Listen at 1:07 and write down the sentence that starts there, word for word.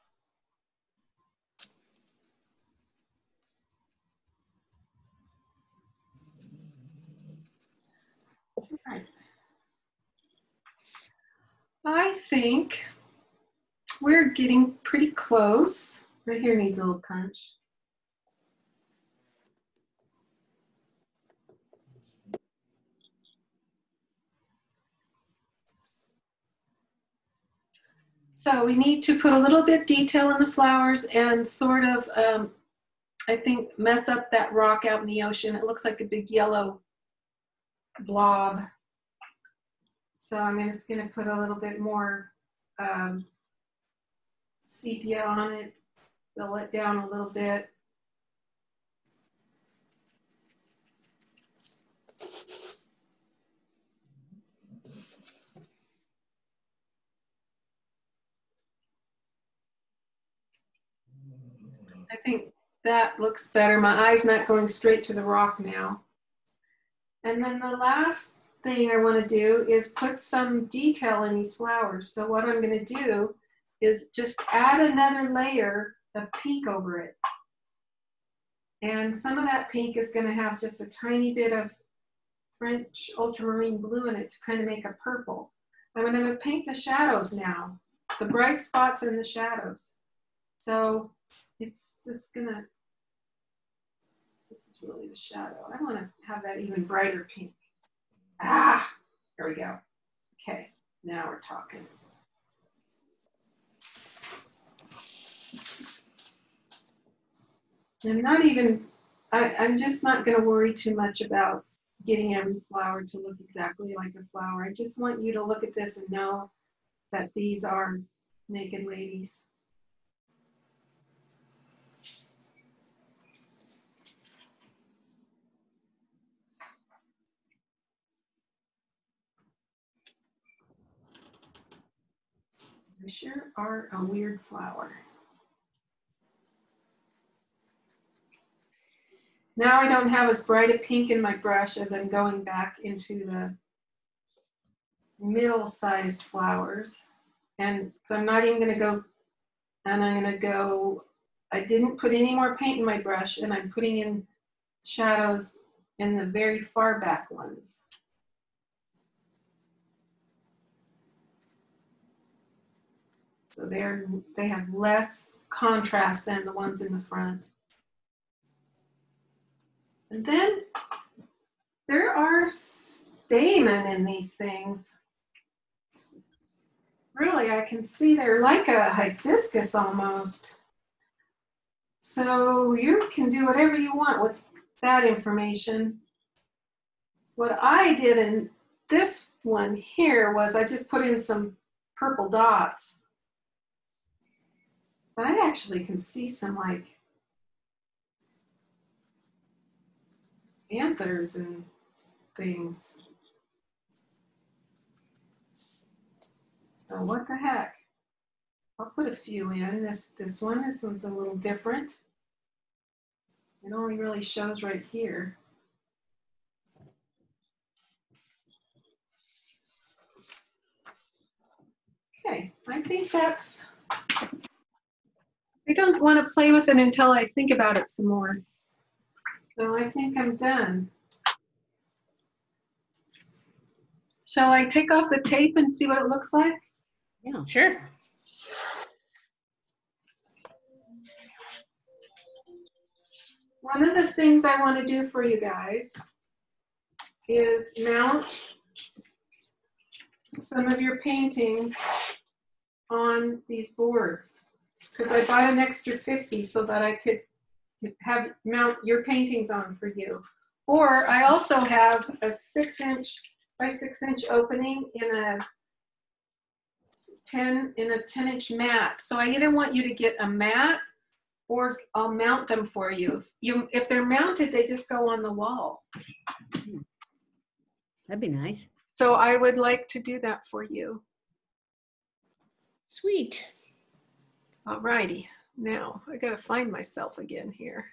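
And then the last thing I want to do is put some detail in these flowers.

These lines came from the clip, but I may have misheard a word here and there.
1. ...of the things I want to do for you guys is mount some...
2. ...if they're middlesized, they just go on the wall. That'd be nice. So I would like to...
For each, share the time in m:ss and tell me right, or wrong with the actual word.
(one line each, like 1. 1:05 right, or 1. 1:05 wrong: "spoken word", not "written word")
1. 4:03 right
2. 4:33 wrong: "mounted", not "middlesized".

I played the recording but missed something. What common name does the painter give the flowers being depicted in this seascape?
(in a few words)
Naked ladies.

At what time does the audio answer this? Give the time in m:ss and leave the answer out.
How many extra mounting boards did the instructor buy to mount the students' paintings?
4:15.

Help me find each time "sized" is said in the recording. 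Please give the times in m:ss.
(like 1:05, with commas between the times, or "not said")
2:25.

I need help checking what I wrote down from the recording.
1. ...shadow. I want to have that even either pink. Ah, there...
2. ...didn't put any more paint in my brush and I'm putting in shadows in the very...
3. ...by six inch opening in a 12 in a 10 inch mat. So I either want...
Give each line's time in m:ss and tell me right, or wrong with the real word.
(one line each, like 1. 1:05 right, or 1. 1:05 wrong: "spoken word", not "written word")
1. 1:35 wrong: "brighter", not "either"
2. 2:31 right
3. 4:23 wrong: "10", not "12".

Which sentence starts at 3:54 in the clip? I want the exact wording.
Shall I take off the tape and see what it looks like?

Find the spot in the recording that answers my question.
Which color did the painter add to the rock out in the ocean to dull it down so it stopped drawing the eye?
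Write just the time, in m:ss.
0:44.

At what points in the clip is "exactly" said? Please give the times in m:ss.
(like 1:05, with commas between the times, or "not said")
1:53.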